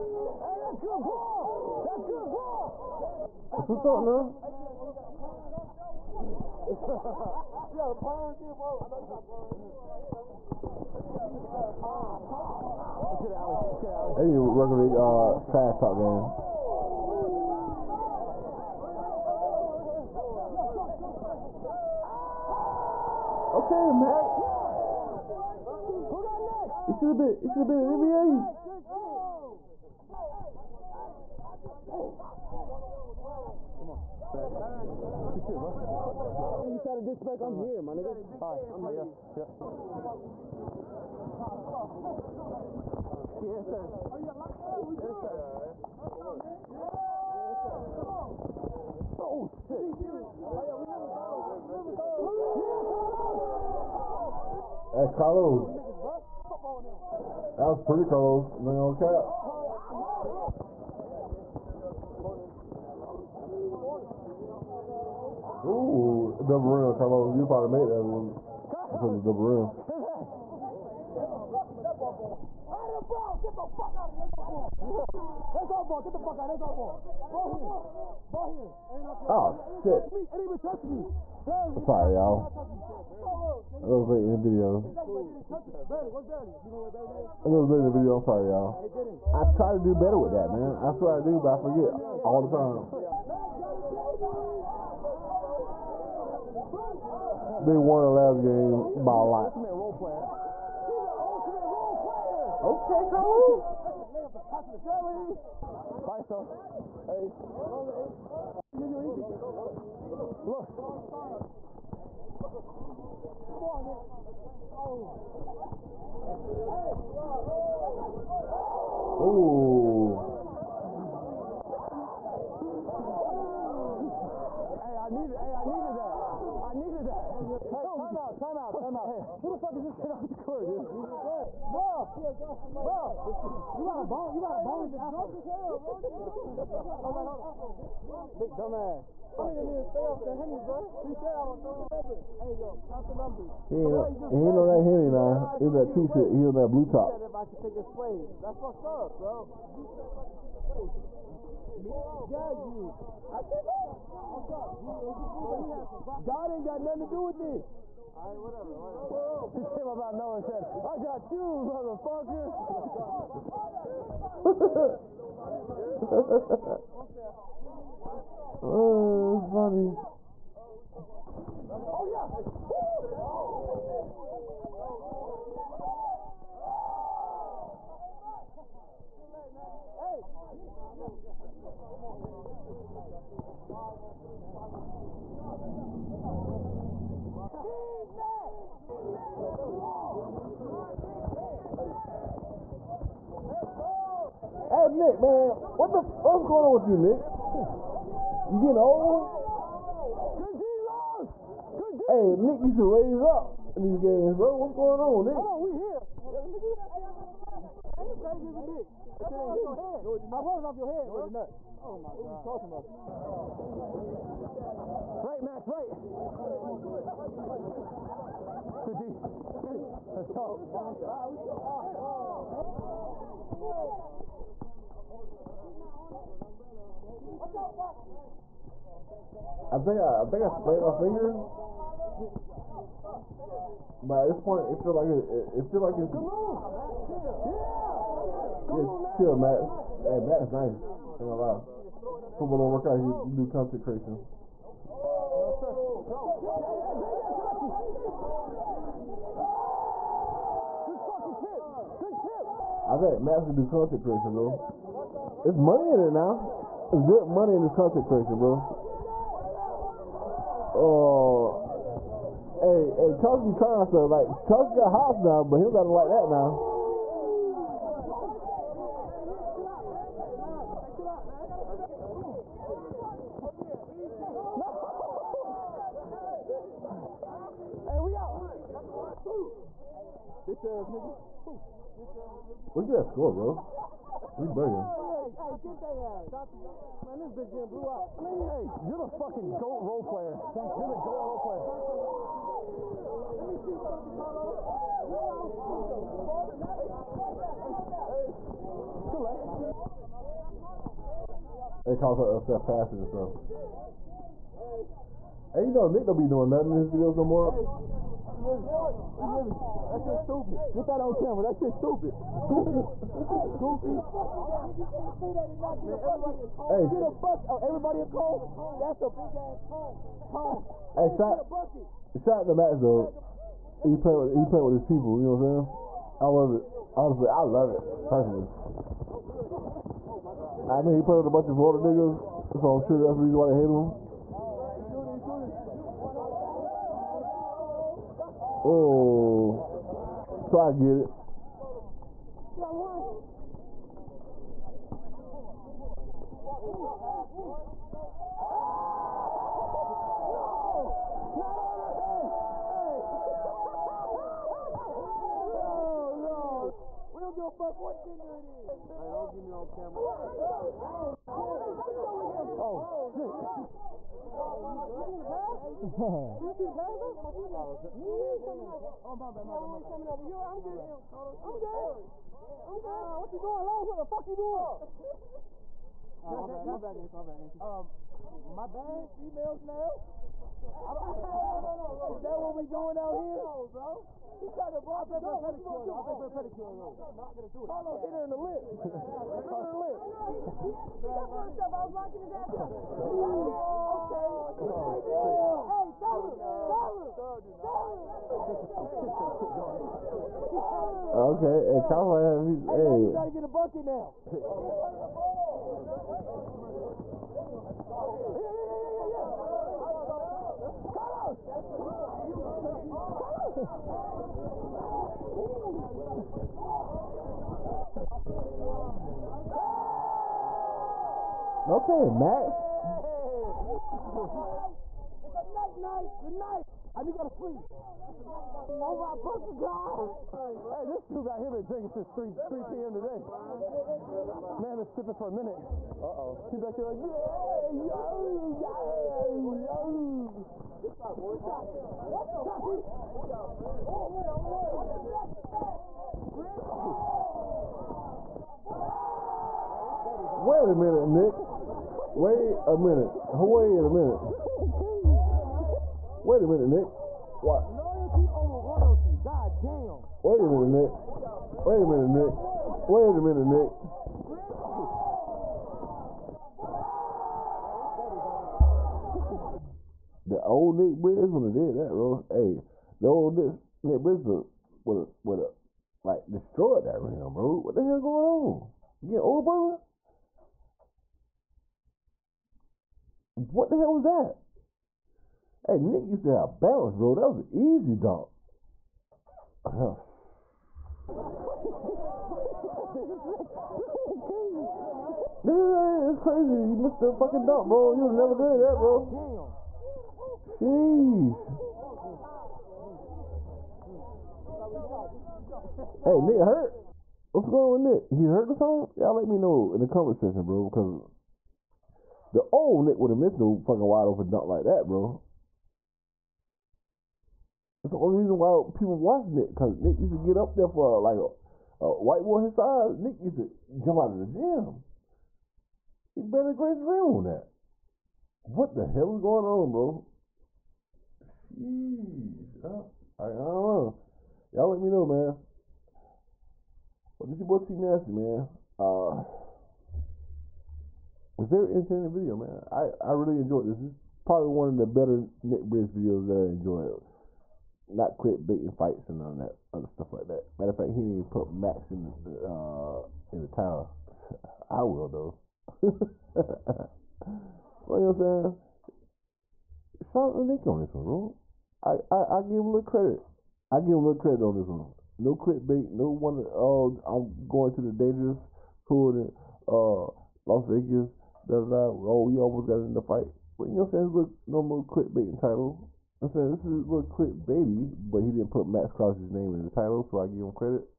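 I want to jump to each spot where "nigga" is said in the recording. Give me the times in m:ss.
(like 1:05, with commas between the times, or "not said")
0:37, 5:31.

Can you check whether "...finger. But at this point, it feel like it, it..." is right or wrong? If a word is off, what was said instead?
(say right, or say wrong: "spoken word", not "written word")
right.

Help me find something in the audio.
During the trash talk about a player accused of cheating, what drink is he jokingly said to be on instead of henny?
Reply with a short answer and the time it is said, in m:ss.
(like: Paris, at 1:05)
blue top, at 2:26.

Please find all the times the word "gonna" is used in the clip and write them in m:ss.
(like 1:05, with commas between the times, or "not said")
4:01, 4:13.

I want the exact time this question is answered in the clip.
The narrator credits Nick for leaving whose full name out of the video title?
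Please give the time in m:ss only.
9:38.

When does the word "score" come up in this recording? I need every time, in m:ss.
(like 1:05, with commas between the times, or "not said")
4:43.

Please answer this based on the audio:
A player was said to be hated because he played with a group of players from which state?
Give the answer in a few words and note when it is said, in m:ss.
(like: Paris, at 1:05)
Florida, at 5:31.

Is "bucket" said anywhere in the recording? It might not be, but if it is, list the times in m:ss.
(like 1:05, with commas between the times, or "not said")
5:17, 6:43.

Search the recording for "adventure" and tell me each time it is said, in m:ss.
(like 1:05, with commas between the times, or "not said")
not said.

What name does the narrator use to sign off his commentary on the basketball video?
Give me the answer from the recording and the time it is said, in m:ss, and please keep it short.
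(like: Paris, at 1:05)
T Nasty, at 8:57.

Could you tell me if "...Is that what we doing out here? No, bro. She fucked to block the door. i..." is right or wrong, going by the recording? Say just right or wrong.
wrong.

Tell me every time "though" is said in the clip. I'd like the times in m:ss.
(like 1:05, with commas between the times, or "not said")
5:22, 6:06, 9:15.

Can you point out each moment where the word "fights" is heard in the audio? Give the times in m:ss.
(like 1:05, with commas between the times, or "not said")
9:08, 9:33.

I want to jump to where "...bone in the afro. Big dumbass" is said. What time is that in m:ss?
2:14.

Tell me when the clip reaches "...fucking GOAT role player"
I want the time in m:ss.
4:49.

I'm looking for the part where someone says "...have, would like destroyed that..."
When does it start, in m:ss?
7:54.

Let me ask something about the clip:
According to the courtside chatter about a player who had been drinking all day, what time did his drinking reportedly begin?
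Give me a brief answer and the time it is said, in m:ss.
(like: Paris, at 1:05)
3 p.m., at 7:12.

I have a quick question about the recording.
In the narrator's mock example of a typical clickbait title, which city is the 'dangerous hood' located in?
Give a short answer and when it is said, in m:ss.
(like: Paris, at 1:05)
Las Vegas, at 9:30.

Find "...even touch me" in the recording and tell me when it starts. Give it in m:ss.
1:20.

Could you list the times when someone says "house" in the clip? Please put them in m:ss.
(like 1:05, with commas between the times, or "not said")
4:24.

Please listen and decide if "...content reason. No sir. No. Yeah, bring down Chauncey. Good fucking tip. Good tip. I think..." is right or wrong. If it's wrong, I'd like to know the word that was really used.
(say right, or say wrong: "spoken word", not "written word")
wrong: "creation", not "reason".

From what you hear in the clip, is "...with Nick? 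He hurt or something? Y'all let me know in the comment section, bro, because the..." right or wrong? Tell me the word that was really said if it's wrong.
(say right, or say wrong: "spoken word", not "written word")
right.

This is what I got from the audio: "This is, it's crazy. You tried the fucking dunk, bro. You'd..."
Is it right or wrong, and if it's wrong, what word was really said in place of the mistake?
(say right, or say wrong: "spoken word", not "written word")
wrong: "missed", not "tried".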